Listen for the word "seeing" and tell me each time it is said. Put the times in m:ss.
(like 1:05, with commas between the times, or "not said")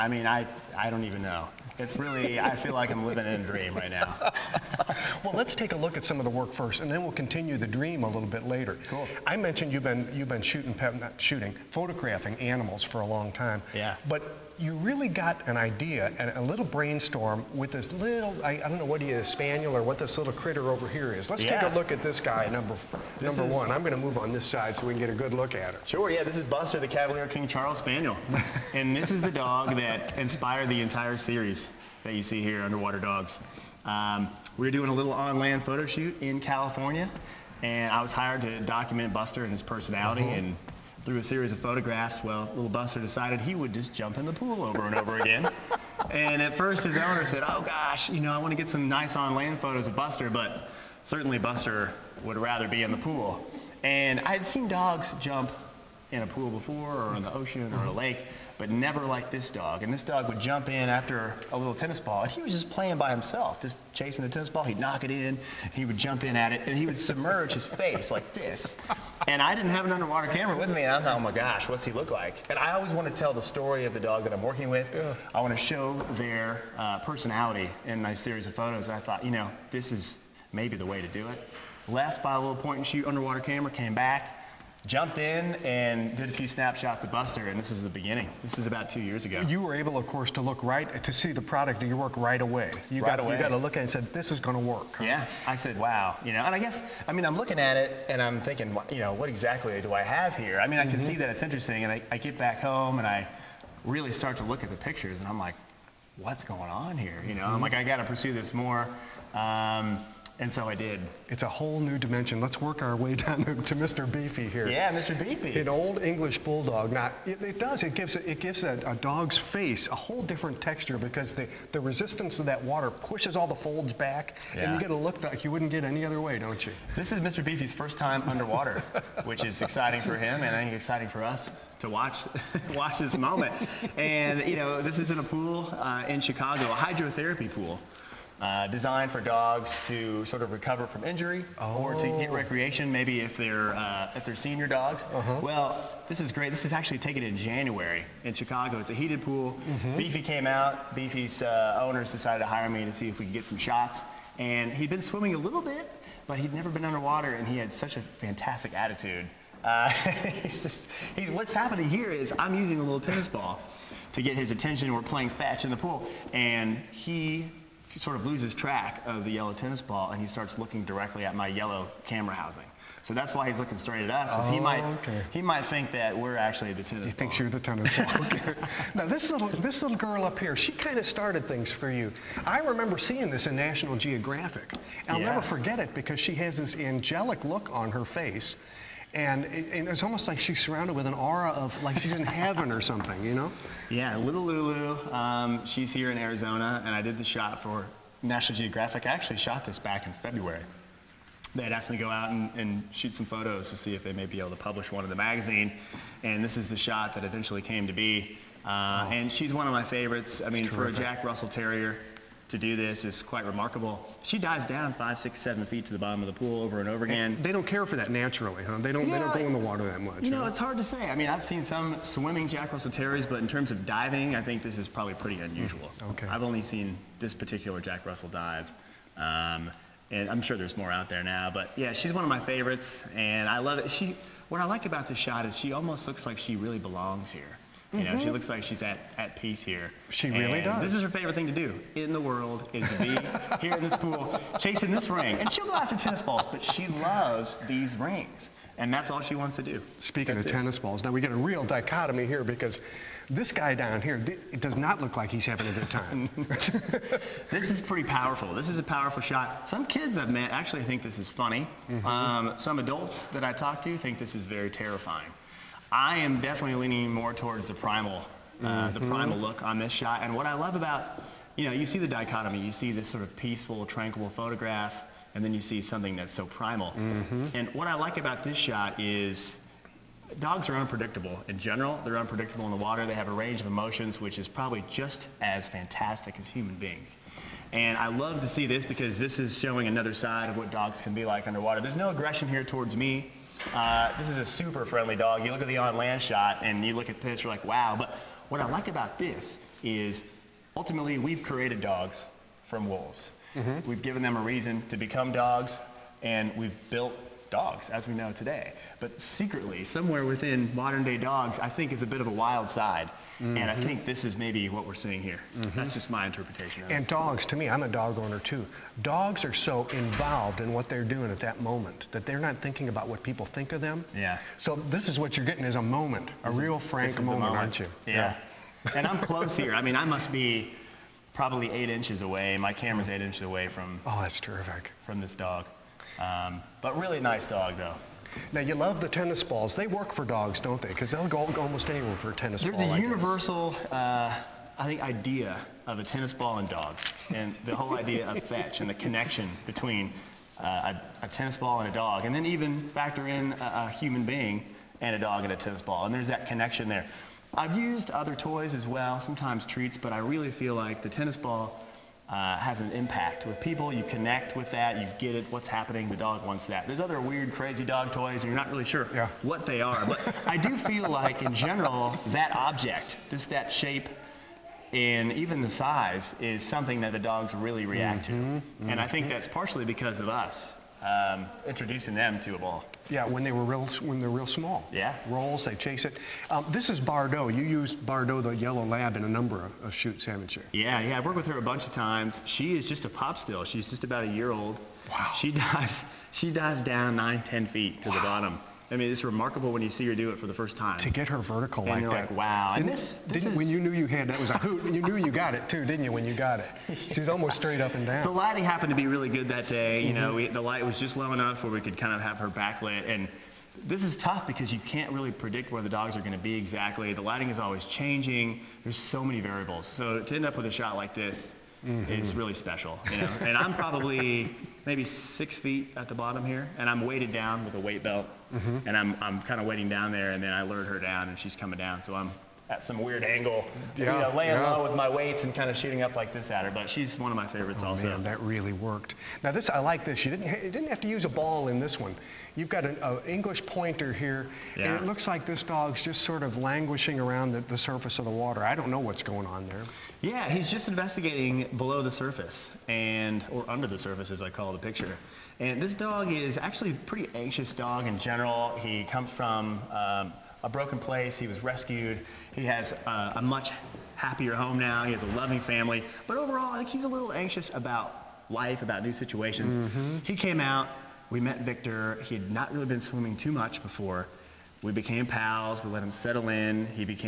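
3:02, 5:15.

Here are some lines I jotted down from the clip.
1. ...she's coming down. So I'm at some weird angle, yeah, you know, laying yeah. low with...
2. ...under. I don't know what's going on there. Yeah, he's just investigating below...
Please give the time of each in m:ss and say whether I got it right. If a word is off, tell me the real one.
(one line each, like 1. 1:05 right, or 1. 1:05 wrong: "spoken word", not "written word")
1. 7:11 right
2. 7:28 wrong: "water", not "under".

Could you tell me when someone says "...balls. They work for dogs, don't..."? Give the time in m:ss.
5:39.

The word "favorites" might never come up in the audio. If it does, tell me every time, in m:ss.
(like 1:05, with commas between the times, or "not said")
3:29, 3:52, 4:01, 7:17.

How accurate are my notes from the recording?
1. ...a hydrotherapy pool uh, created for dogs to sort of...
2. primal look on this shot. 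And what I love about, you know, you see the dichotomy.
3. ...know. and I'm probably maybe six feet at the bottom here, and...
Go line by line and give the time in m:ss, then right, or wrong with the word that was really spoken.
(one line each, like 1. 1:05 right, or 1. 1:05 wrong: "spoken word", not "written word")
1. 2:16 wrong: "designed", not "created"
2. 4:29 right
3. 7:03 right.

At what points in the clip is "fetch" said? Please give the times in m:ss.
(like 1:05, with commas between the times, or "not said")
2:45, 5:48.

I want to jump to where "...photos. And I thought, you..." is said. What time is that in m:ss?
1:18.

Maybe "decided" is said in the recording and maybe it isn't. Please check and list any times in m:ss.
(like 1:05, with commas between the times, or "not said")
0:42, 2:32.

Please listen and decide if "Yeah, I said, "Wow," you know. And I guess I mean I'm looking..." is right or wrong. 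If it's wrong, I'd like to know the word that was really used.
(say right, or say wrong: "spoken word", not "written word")
right.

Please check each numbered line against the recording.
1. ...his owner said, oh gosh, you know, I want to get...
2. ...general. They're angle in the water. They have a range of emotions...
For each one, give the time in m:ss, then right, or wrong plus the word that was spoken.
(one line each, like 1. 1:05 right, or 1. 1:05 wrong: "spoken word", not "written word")
1. 0:46 right
2. 4:41 wrong: "unpredictable", not "angle".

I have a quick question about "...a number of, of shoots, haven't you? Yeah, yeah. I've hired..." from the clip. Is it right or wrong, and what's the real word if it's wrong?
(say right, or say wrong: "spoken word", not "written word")
wrong: "worked", not "hired".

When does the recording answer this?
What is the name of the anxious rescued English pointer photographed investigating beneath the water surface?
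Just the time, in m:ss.
7:51.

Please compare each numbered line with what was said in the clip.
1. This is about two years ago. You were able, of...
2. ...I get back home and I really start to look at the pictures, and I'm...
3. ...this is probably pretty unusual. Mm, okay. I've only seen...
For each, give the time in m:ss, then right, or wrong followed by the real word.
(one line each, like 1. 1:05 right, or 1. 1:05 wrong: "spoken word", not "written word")
1. 1:28 right
2. 1:42 right
3. 3:44 right.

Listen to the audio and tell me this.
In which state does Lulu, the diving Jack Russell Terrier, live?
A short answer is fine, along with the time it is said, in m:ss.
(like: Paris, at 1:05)
Arizona, at 3:16.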